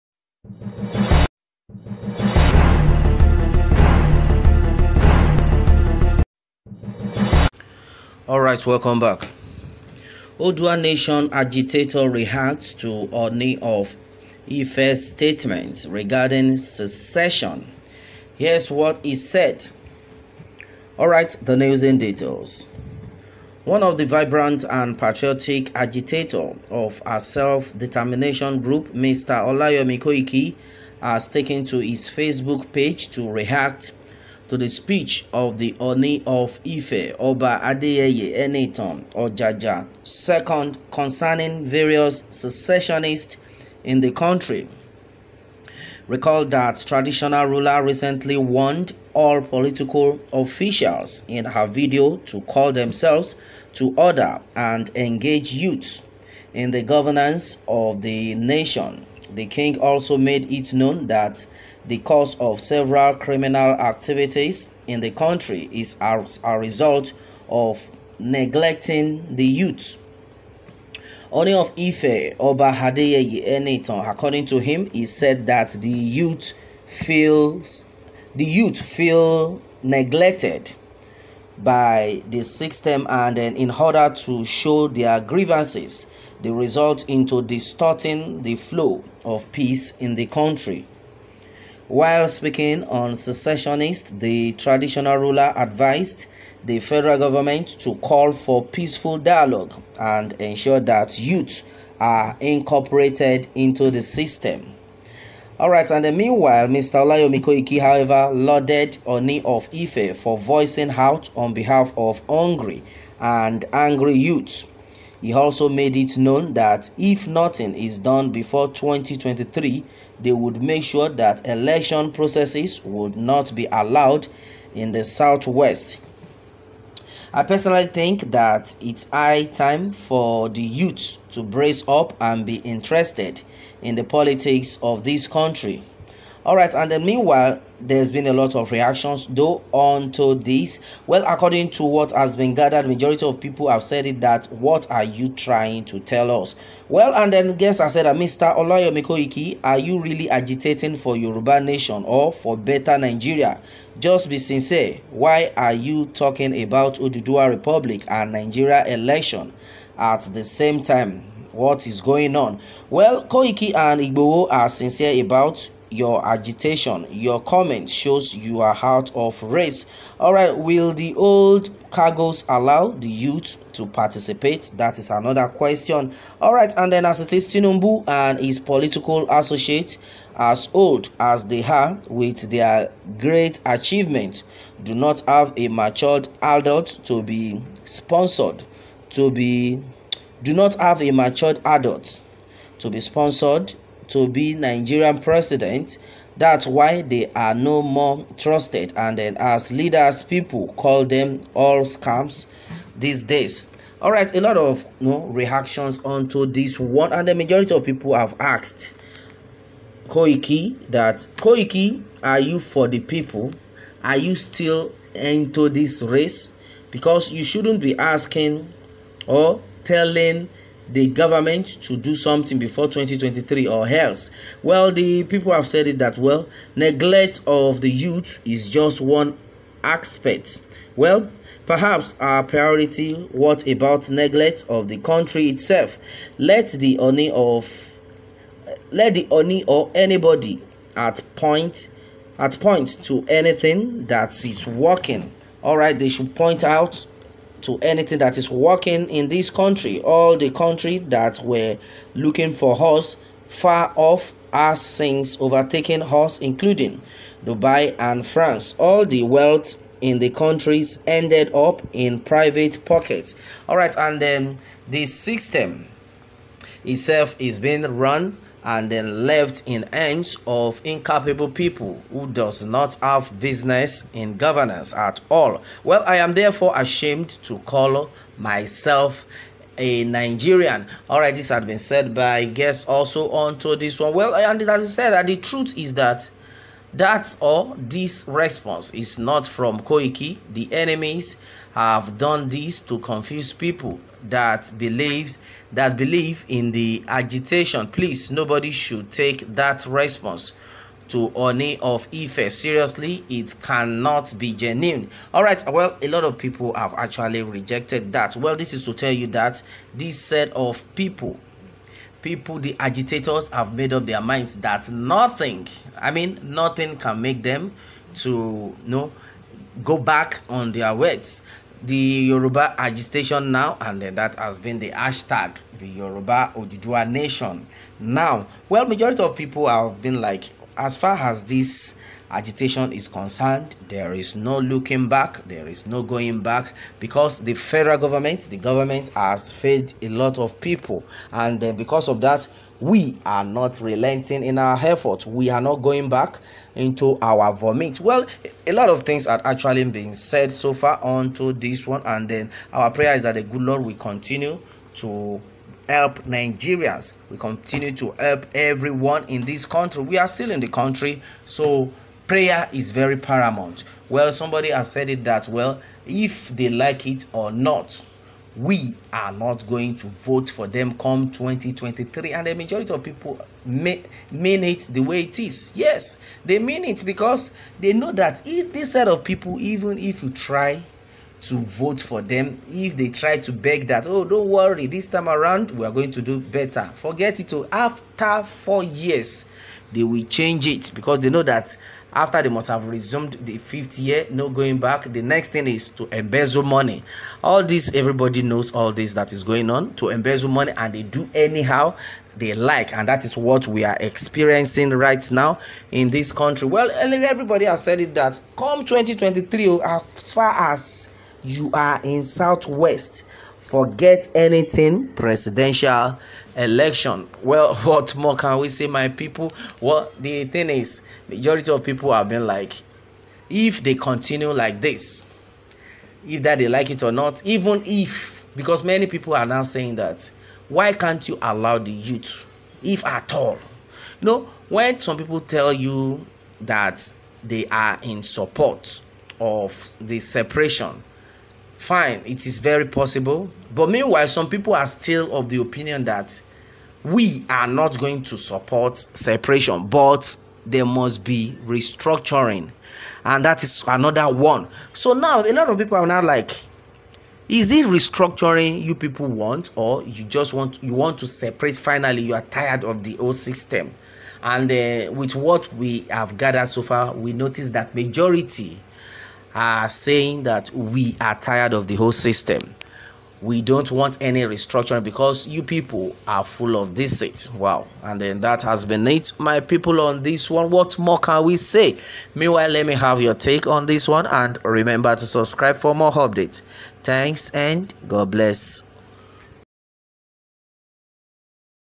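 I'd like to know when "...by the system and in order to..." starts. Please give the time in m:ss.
1:21.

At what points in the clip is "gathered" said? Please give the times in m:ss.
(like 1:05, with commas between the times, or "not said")
2:22, 7:46.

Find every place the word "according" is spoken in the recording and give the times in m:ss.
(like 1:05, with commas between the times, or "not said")
1:14, 2:21.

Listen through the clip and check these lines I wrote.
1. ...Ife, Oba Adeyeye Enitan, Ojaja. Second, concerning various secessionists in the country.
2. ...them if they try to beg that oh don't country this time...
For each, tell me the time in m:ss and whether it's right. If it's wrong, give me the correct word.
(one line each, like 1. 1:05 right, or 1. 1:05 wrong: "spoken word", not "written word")
1. 0:36 right
2. 6:22 wrong: "worry", not "country".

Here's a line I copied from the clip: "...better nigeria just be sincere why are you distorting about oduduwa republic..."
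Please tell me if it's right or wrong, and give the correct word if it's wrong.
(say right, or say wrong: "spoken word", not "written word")
wrong: "talking", not "distorting".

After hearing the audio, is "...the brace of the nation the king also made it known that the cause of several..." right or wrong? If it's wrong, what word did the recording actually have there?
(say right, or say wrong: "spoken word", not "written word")
wrong: "governance", not "brace".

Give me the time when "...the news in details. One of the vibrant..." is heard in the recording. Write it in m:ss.
0:21.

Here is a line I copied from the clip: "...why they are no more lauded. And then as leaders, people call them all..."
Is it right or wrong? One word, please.
wrong.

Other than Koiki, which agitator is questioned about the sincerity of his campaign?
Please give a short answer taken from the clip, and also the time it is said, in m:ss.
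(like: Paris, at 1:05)
Igboho, at 2:44.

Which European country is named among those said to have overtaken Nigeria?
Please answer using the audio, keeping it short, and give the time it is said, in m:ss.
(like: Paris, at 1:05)
France, at 4:18.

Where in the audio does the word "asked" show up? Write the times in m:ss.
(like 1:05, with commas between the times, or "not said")
3:28.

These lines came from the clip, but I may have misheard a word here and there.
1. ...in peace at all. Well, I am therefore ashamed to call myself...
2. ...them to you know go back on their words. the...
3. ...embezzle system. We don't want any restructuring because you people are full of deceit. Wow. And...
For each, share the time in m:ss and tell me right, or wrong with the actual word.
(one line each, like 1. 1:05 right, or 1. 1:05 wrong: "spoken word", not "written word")
1. 4:34 wrong: "governance", not "peace"
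2. 5:17 right
3. 7:51 wrong: "whole", not "embezzle".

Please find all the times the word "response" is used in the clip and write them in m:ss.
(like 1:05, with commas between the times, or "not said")
4:48, 4:59.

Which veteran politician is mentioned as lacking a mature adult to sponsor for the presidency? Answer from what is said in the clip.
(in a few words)
Tinubu.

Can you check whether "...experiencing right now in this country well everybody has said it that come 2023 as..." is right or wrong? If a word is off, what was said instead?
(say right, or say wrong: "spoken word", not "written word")
right.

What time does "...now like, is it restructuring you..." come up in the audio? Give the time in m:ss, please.
7:36.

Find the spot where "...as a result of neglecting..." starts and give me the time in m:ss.
1:06.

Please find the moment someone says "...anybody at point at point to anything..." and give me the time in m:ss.
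3:59.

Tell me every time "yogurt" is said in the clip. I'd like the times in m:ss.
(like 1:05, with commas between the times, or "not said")
not said.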